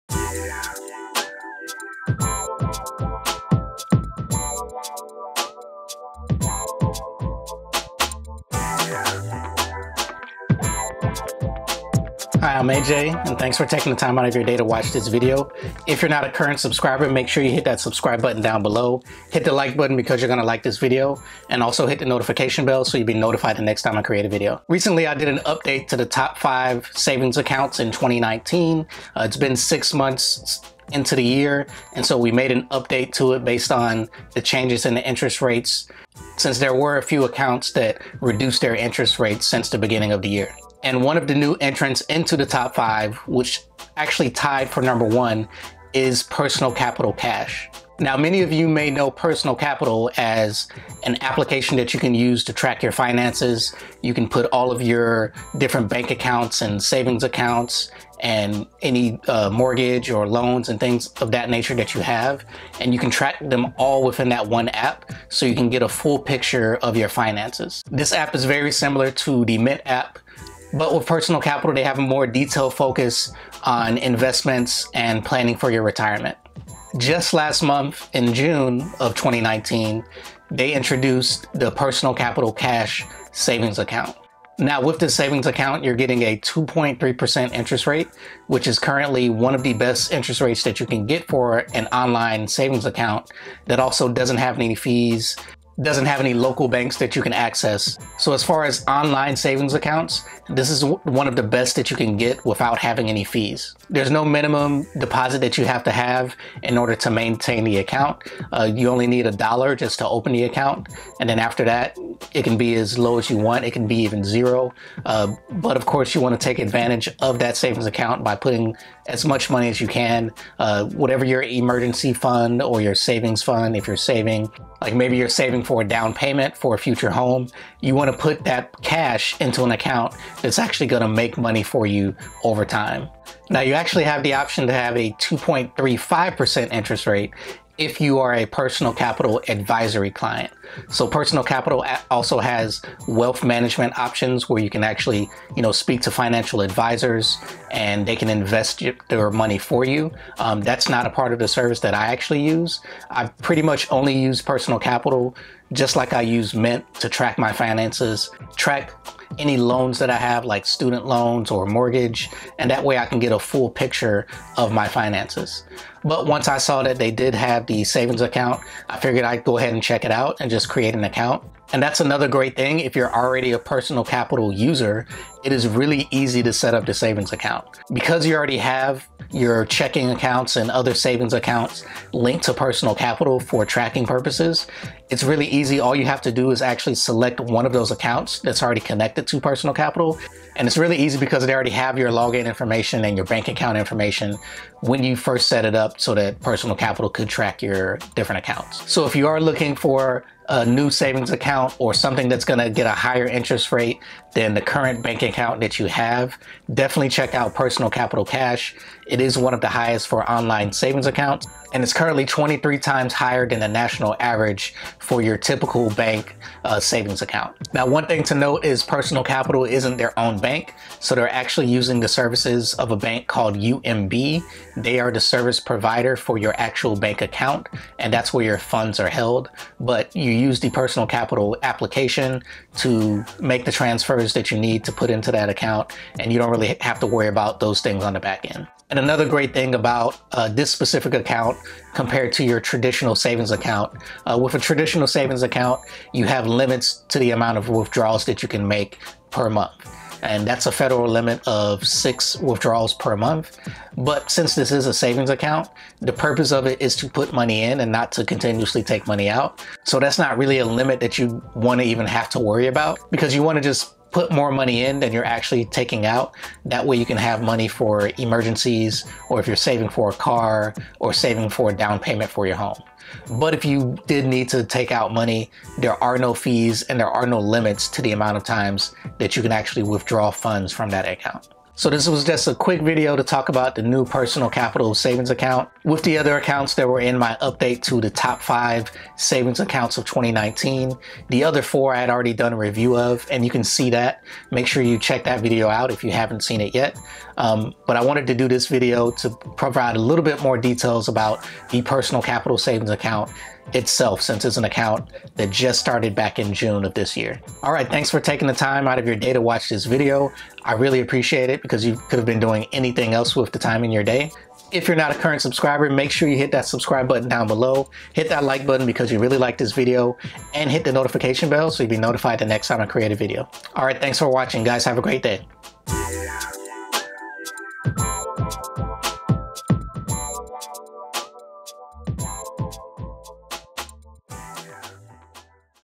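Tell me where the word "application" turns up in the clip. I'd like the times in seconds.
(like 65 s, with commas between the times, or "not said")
51 s, 231 s.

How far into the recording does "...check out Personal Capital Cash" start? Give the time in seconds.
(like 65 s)
207 s.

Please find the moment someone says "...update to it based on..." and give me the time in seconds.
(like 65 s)
32 s.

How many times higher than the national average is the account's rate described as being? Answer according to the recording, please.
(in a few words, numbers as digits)
23.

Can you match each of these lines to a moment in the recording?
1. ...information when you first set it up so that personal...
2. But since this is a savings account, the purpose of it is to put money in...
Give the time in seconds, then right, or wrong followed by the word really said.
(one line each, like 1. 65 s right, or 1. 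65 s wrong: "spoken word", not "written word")
1. 193 s right
2. 253 s right.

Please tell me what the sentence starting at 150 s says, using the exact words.
Um, that's not a part of the service that I actually use.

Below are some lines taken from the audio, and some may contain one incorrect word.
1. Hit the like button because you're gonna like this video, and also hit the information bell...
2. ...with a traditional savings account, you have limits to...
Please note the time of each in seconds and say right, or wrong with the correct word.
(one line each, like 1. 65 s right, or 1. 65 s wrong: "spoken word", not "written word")
1. 19 s wrong: "notification", not "information"
2. 244 s right.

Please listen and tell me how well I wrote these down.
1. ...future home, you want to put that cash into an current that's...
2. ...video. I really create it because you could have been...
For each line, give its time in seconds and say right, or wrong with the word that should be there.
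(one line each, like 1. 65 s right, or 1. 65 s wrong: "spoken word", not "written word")
1. 126 s wrong: "account", not "current"
2. 309 s wrong: "appreciate", not "create".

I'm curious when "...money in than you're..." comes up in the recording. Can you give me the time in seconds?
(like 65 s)
264 s.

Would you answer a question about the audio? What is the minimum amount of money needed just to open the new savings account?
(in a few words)
a dollar.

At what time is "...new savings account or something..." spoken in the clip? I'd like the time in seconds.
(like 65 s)
200 s.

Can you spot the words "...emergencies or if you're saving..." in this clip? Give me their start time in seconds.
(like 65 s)
268 s.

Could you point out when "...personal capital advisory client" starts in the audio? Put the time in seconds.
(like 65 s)
138 s.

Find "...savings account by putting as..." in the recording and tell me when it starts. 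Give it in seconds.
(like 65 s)
117 s.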